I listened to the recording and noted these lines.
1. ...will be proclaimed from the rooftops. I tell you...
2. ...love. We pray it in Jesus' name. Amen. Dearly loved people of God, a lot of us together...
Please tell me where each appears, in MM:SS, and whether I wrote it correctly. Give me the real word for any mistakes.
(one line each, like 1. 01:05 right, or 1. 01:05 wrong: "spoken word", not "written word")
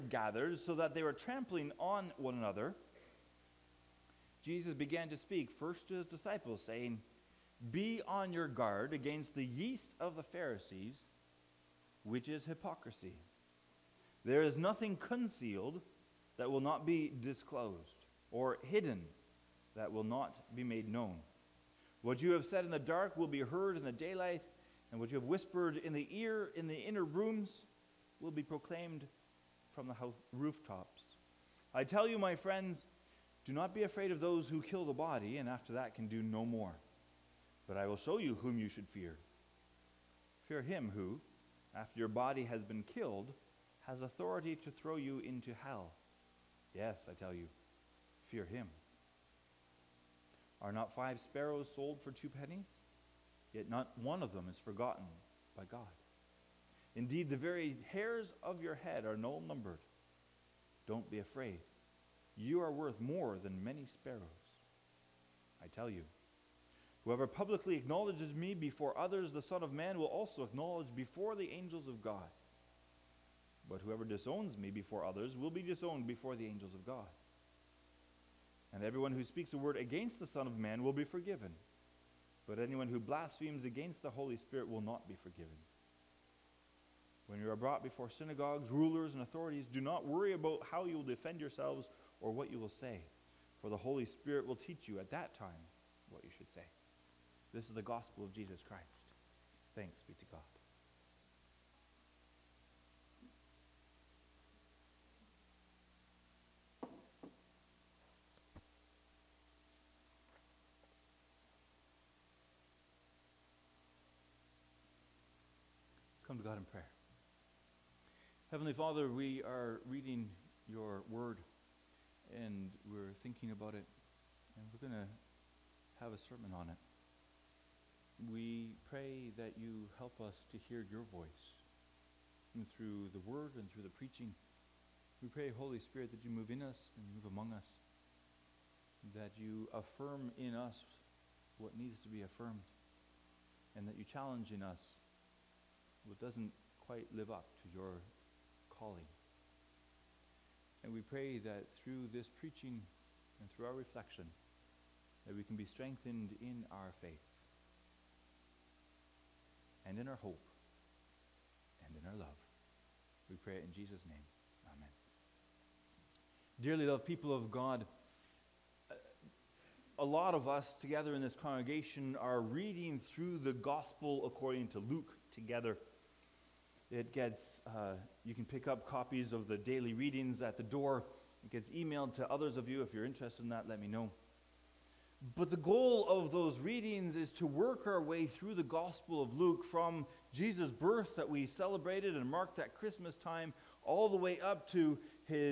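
1. 00:28 right
2. 02:42 right.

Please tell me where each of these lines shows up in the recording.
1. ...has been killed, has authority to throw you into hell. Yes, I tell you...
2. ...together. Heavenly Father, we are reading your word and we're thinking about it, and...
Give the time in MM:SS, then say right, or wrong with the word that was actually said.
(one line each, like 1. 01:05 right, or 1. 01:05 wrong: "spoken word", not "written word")
1. 00:42 right
2. 01:56 wrong: "prayer", not "together".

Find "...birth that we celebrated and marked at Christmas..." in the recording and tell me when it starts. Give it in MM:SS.
03:10.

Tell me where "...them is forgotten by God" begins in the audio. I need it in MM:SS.
00:54.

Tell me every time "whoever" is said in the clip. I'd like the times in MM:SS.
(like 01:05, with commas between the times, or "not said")
01:07, 01:13.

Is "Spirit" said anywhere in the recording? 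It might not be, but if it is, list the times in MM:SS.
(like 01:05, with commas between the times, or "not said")
01:24, 01:34, 02:15.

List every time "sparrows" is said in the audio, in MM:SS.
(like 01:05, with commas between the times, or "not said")
00:51, 01:03.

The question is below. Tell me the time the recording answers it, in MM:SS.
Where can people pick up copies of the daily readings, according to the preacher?
03:00.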